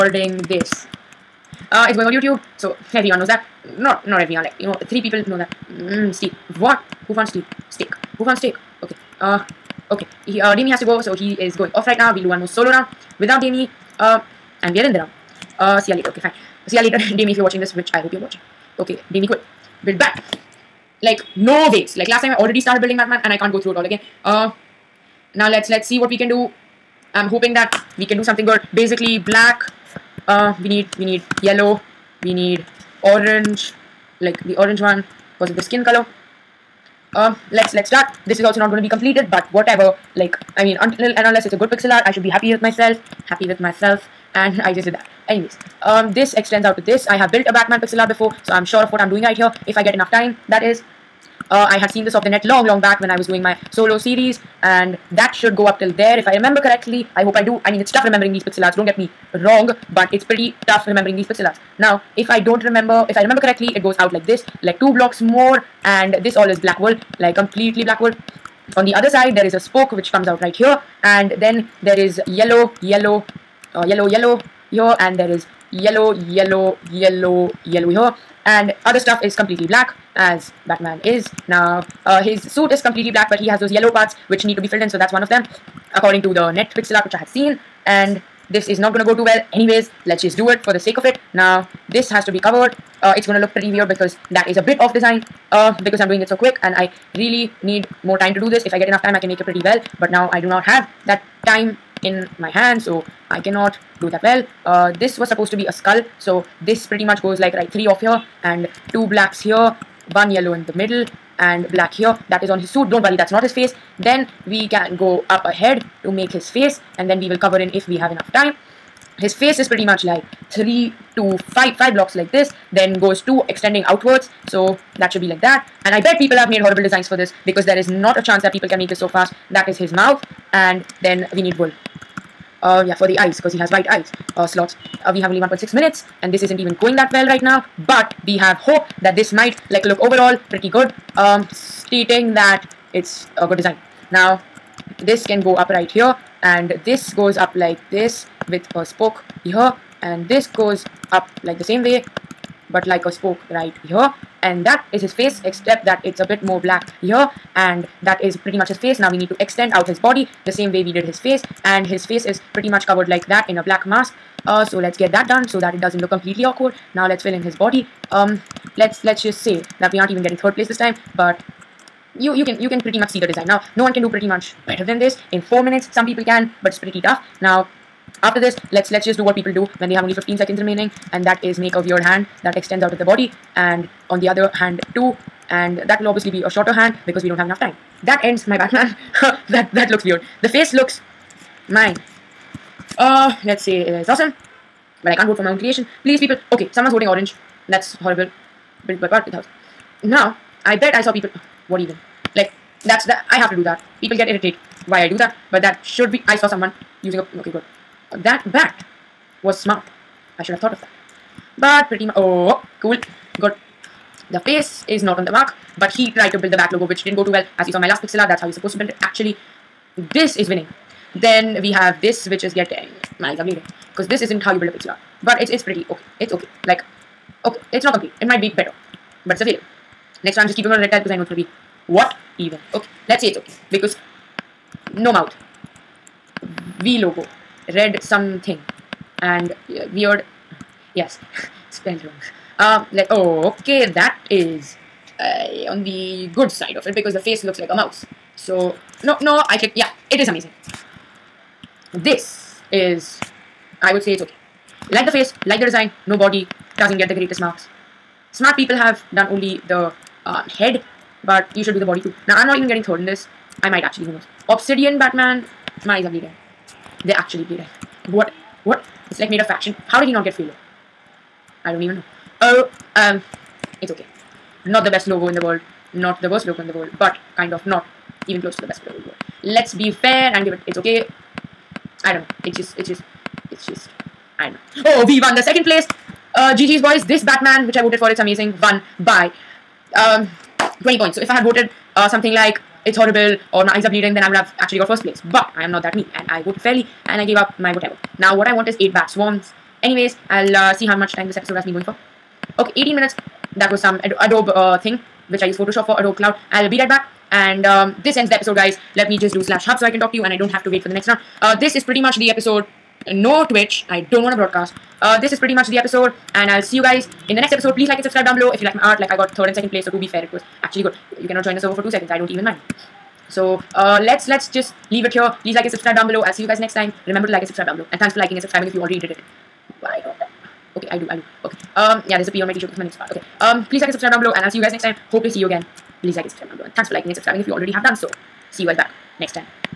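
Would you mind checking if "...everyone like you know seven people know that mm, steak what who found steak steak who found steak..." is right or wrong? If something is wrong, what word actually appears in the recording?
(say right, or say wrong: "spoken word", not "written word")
wrong: "three", not "seven".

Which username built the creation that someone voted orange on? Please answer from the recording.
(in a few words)
Parth2000.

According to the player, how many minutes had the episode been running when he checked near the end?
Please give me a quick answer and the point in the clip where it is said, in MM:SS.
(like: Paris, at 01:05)
18, at 05:02.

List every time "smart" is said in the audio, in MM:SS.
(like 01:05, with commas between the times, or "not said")
03:29, 04:18.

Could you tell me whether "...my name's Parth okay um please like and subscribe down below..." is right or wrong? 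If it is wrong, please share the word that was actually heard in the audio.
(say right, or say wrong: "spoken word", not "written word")
right.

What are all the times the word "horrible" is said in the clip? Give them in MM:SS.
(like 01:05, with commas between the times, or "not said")
02:06, 03:18, 04:52.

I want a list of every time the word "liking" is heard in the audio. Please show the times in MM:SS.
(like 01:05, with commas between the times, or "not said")
05:28, 05:36.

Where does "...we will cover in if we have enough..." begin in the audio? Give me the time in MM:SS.
01:57.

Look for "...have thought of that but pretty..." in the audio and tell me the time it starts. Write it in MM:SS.
03:30.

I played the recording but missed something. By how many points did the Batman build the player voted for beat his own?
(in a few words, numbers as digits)
20.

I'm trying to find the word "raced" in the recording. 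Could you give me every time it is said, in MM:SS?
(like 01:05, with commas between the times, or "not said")
not said.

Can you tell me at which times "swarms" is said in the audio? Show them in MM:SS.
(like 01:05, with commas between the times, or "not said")
04:59.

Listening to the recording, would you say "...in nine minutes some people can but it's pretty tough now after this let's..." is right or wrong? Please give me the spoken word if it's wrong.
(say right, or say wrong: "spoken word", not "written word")
wrong: "four", not "nine".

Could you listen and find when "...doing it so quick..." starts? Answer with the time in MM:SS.
01:36.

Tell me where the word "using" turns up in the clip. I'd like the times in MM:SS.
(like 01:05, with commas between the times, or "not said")
03:27.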